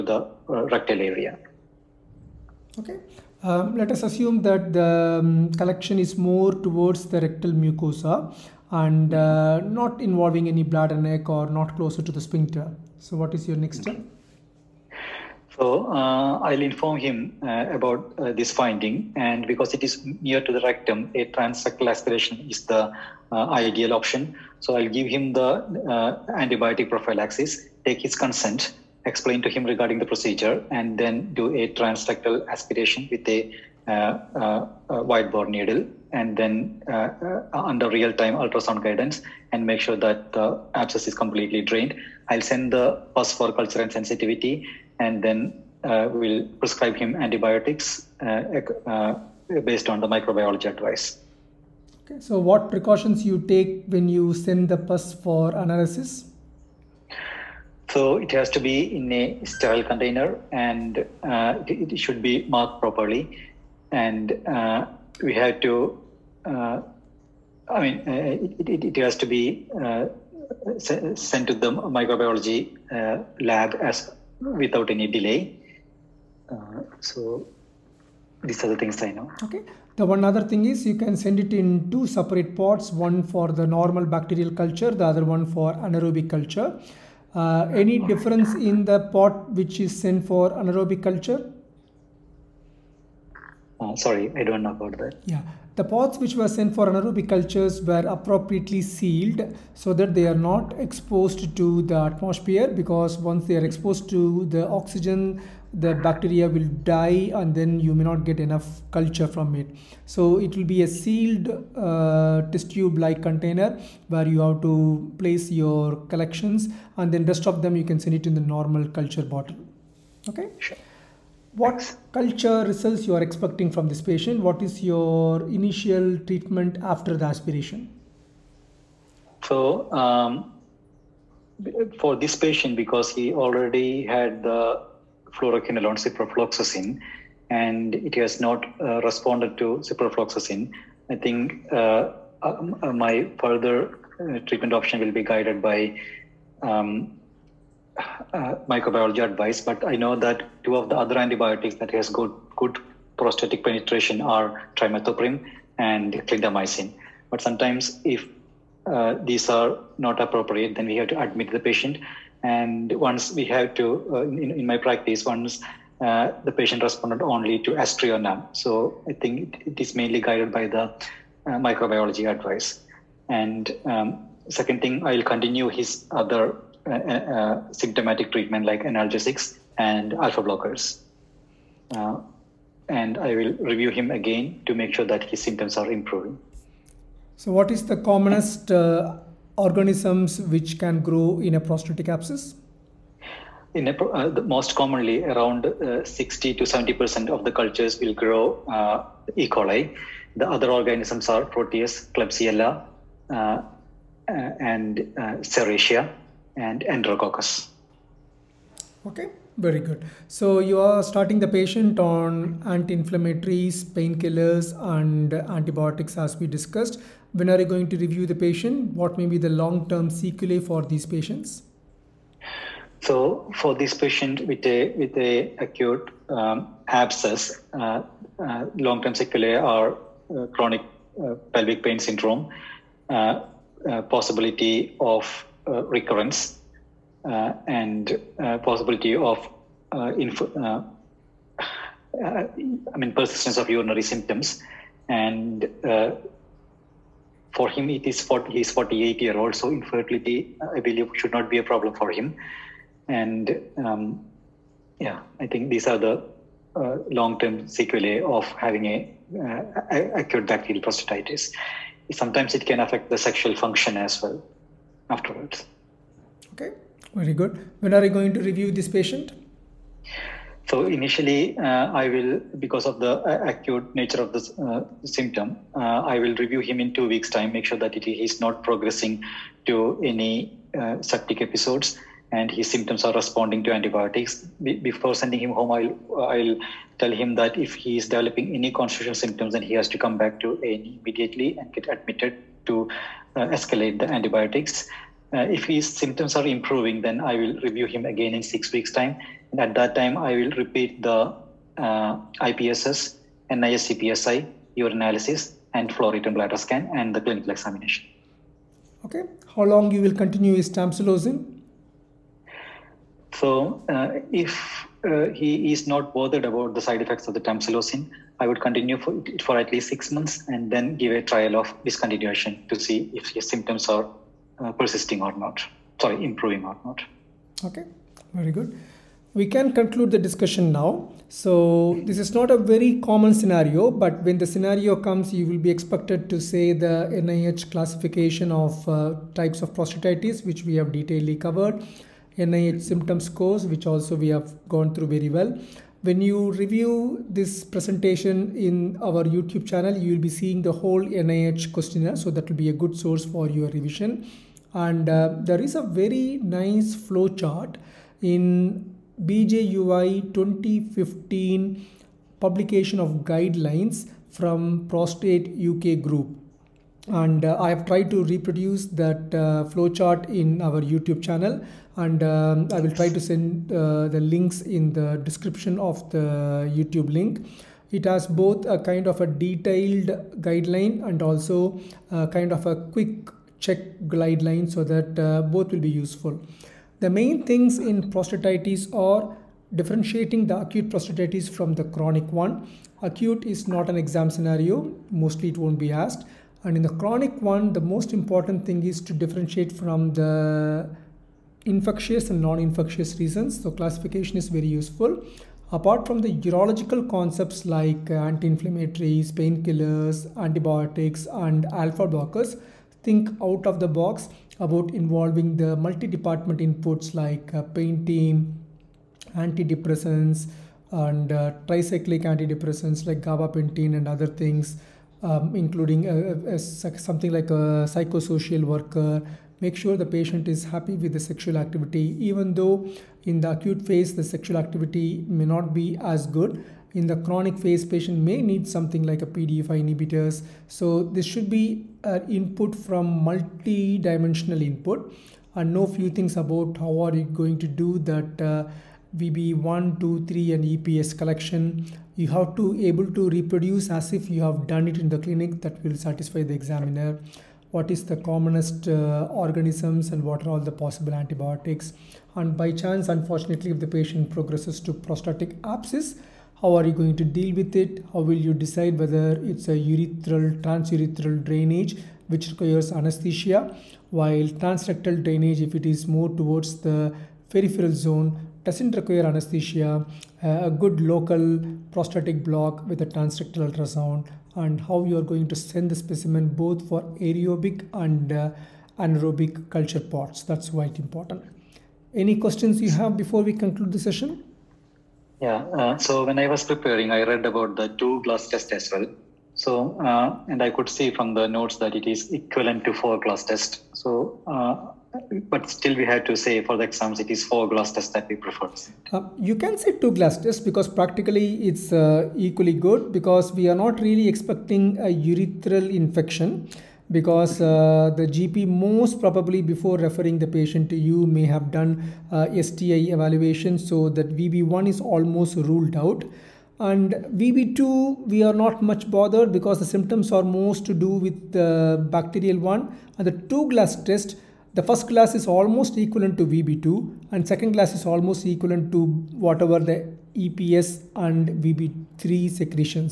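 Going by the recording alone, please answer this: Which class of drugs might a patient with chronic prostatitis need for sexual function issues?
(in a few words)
PDE inhibitors.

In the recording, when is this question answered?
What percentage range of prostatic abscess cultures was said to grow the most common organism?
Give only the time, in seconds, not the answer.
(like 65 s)
196 s.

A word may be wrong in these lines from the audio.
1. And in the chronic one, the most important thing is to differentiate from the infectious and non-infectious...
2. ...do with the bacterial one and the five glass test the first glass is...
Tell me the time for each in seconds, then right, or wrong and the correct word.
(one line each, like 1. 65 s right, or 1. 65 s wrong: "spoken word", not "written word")
1. 396 s right
2. 530 s wrong: "two", not "five".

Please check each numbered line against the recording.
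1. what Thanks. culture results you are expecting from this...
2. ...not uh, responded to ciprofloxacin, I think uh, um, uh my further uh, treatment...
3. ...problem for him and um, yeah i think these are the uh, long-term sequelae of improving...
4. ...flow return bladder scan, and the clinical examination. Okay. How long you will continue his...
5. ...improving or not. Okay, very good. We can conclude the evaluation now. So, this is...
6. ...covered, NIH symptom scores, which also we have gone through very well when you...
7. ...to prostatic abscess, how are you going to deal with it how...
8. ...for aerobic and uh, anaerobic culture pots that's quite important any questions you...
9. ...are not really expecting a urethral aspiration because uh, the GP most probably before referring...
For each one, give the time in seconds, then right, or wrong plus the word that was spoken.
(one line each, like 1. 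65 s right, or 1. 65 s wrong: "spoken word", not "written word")
1. 121 s right
2. 138 s right
3. 251 s wrong: "having", not "improving"
4. 305 s right
5. 326 s wrong: "discussion", not "evaluation"
6. 341 s right
7. 464 s right
8. 486 s right
9. 513 s wrong: "infection", not "aspiration".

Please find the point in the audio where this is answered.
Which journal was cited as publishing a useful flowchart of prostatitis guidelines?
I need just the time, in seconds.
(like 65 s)
359 s.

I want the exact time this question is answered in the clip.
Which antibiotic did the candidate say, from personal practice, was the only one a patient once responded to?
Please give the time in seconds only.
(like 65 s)
167 s.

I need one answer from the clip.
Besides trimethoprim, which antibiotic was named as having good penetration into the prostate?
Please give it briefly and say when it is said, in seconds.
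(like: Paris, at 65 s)
Clindamycin, at 156 s.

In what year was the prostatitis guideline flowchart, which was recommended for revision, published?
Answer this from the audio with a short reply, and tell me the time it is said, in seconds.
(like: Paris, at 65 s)
2015, at 360 s.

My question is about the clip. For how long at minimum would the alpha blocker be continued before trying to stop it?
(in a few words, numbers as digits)
6 months.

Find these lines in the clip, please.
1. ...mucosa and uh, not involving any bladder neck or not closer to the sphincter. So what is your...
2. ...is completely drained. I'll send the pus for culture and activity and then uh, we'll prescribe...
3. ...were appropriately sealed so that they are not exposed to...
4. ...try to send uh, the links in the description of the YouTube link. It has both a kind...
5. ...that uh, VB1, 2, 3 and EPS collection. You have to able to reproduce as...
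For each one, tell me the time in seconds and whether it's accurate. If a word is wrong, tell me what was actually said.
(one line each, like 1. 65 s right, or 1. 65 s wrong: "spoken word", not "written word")
1. 7 s right
2. 41 s wrong: "sensitivity", not "activity"
3. 97 s right
4. 372 s right
5. 447 s right.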